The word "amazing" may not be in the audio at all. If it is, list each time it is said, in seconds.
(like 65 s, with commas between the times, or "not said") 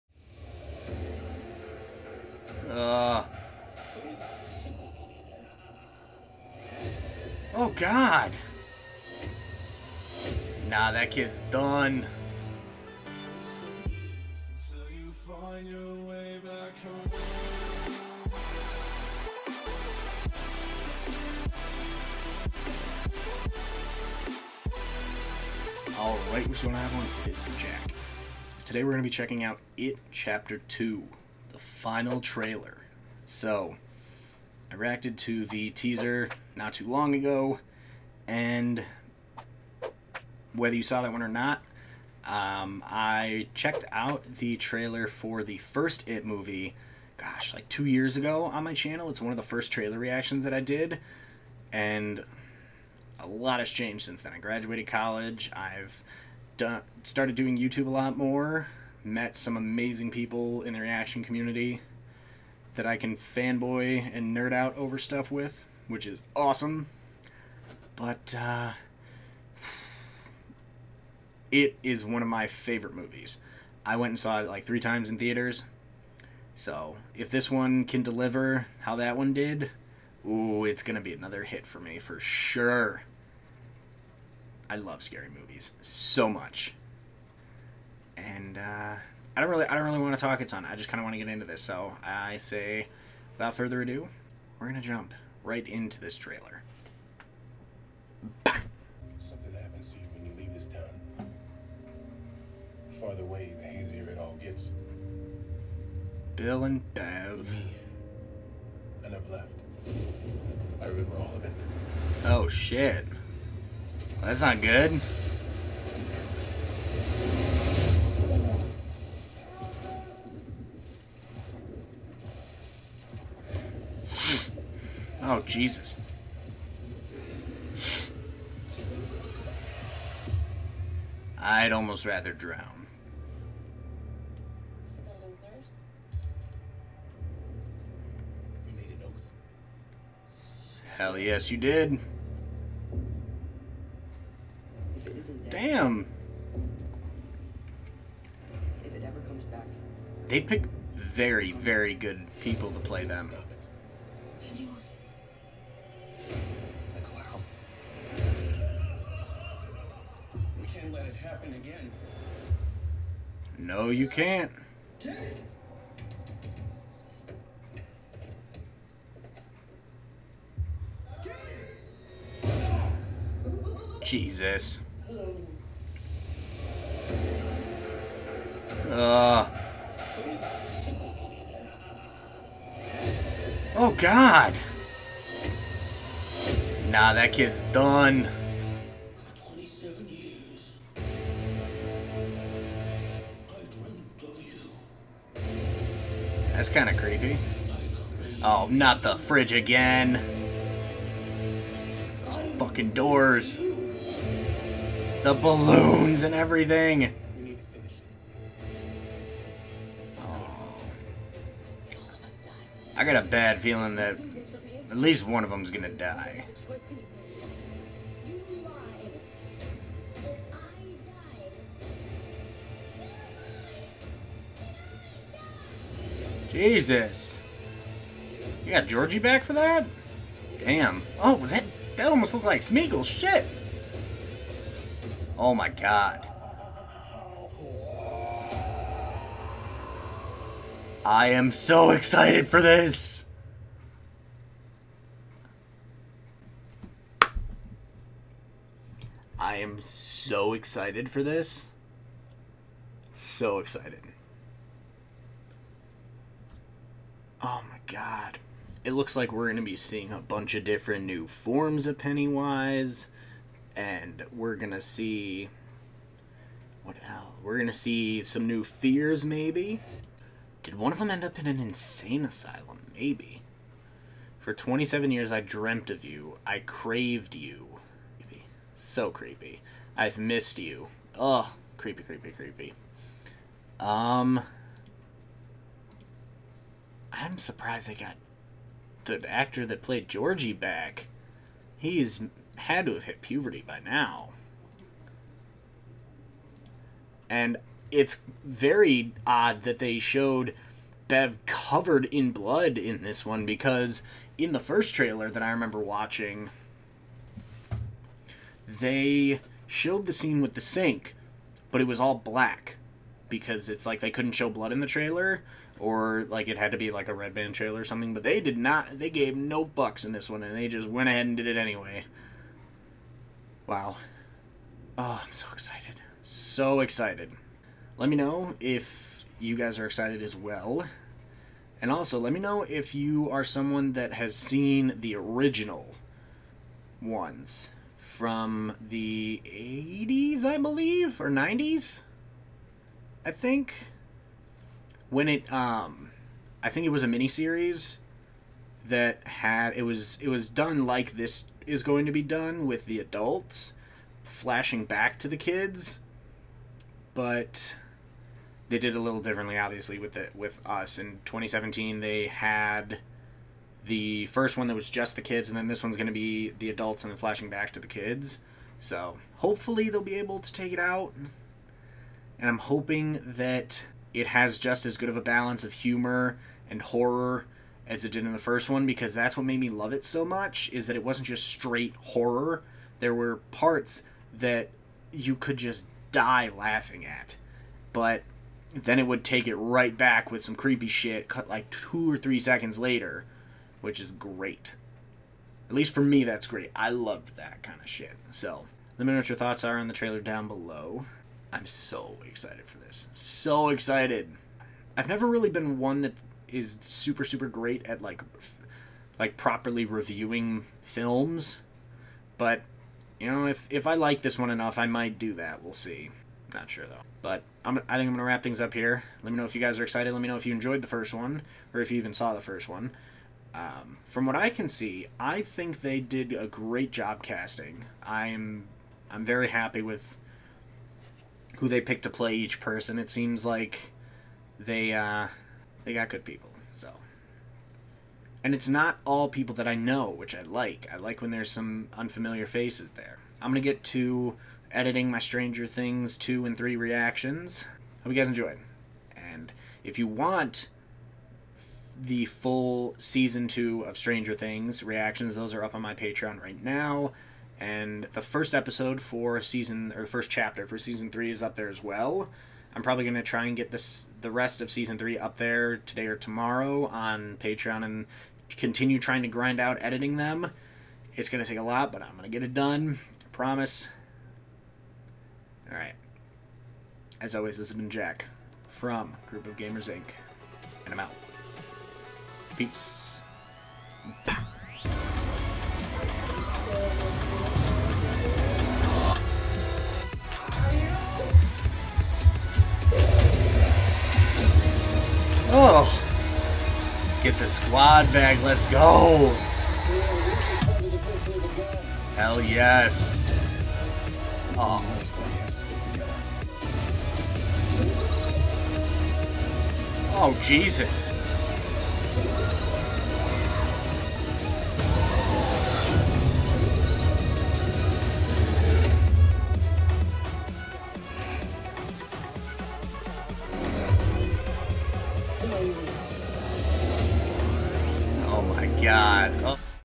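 59 s.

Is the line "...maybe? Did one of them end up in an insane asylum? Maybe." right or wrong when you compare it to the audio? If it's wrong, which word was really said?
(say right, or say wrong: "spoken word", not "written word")
right.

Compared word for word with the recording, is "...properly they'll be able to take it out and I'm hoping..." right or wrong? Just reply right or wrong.
wrong.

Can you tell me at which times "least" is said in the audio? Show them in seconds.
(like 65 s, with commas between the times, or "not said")
214 s, 395 s.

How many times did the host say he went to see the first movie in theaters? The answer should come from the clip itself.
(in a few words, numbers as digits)
3.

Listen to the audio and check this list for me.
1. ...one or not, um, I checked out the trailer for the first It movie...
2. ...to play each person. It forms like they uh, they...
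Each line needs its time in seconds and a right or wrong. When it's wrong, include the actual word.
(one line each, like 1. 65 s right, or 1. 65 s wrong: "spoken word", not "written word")
1. 41 s right
2. 432 s wrong: "seems", not "forms".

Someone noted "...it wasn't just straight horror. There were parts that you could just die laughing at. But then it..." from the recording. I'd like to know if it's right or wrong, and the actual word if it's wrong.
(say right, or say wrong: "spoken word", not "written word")
right.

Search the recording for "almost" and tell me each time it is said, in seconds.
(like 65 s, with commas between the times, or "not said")
131 s, 232 s.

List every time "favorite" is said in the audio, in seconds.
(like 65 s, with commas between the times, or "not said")
72 s.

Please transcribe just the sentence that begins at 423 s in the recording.
Um, from what I can see, I think they did a great job casting.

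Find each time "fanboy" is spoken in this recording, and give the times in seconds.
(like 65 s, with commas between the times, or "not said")
63 s.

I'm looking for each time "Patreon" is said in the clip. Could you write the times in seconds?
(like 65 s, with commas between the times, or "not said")
455 s, 467 s.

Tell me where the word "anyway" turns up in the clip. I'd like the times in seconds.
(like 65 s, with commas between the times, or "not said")
321 s.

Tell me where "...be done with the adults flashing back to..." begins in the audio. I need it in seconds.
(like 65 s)
352 s.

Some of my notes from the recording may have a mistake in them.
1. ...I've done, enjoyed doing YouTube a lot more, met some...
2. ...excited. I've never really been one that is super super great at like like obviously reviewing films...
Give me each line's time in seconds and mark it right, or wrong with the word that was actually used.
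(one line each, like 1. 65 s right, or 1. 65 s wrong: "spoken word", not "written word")
1. 55 s wrong: "started", not "enjoyed"
2. 403 s wrong: "properly", not "obviously".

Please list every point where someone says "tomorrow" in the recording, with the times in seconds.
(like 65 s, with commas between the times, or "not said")
466 s.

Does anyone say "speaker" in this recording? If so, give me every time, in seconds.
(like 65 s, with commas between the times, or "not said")
not said.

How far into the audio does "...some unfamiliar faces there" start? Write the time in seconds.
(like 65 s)
441 s.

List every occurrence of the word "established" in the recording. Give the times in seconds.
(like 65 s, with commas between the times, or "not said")
not said.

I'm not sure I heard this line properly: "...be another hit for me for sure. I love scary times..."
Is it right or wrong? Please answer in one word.
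wrong.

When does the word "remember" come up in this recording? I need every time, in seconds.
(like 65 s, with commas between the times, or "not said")
110 s, 305 s.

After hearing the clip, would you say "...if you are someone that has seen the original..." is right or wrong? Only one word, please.
right.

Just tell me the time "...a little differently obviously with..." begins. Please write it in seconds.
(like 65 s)
358 s.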